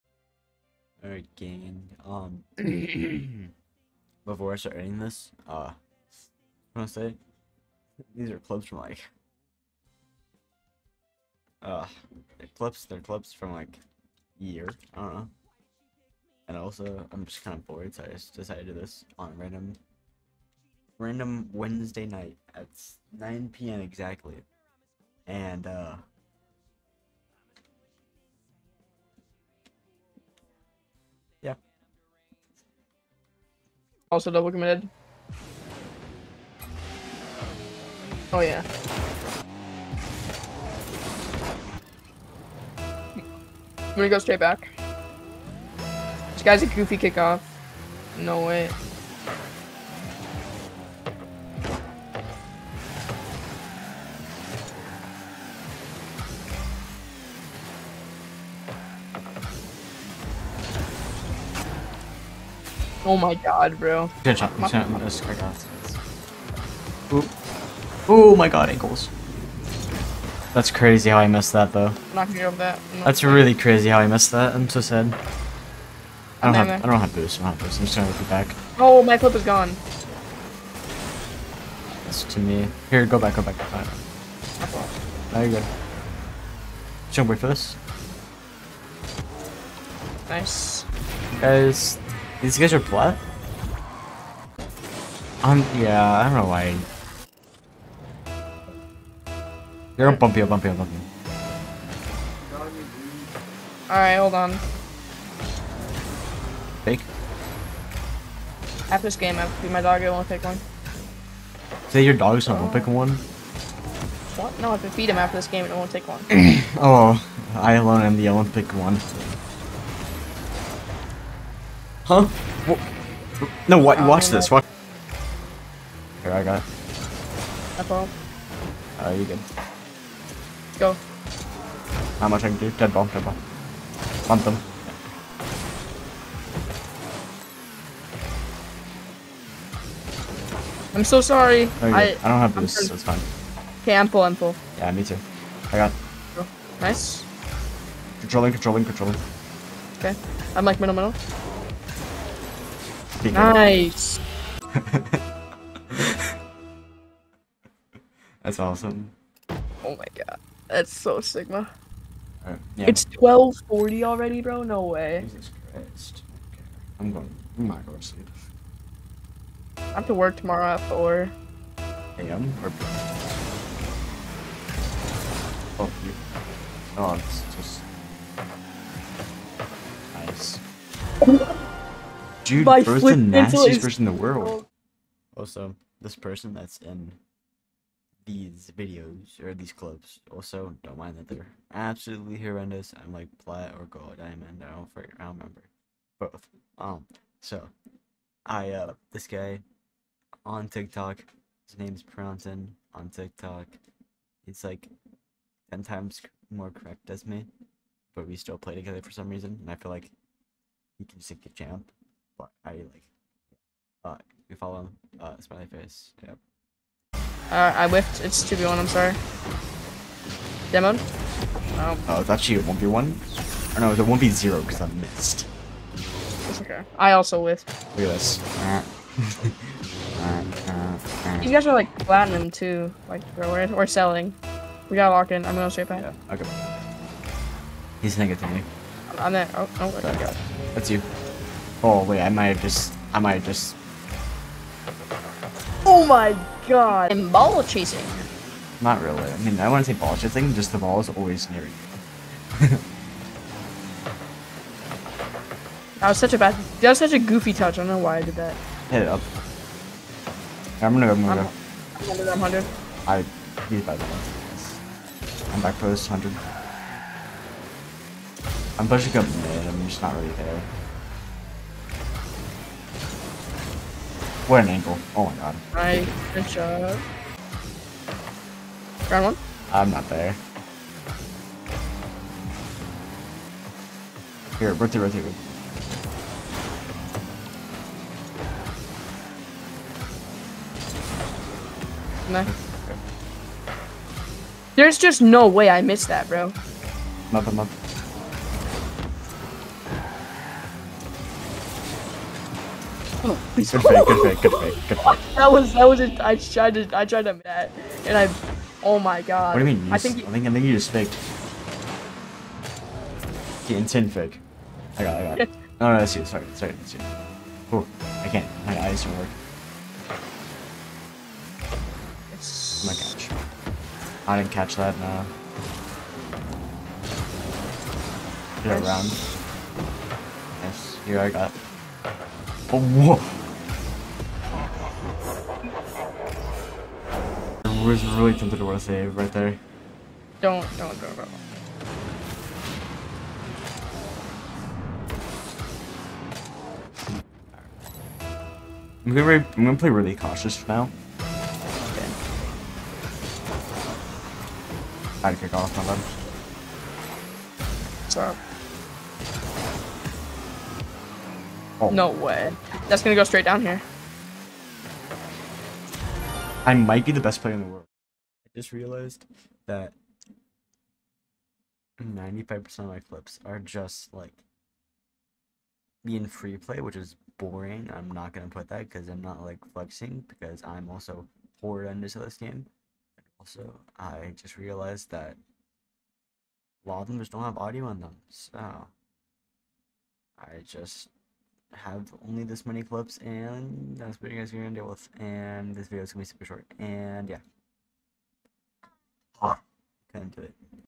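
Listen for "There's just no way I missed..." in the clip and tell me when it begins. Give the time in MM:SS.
04:54.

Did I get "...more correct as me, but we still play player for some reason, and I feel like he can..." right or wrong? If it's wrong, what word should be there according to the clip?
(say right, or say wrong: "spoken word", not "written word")
wrong: "together", not "player".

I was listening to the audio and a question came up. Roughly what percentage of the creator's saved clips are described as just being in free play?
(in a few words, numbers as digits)
95%.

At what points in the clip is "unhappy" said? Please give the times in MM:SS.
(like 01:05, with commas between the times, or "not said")
not said.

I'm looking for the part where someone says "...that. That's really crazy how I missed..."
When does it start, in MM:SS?
01:12.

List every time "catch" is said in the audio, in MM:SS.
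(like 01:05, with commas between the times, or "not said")
05:24.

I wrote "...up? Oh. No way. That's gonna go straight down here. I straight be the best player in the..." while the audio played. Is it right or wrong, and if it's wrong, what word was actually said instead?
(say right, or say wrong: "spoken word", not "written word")
wrong: "might", not "straight".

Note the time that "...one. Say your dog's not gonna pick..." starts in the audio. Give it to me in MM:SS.
01:50.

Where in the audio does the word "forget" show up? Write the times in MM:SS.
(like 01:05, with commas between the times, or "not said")
03:14.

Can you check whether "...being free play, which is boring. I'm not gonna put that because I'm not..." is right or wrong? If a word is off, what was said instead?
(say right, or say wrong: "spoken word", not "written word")
right.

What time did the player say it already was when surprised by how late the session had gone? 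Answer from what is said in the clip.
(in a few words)
12:40.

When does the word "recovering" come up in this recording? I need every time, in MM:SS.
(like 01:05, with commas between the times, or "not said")
not said.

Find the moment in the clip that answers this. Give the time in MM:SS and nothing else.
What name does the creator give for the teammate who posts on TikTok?
03:22.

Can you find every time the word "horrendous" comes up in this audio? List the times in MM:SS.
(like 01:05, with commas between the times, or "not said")
03:12, 06:21.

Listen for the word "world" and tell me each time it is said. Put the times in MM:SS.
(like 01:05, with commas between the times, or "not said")
03:04, 06:07.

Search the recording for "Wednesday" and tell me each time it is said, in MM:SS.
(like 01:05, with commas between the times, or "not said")
00:21.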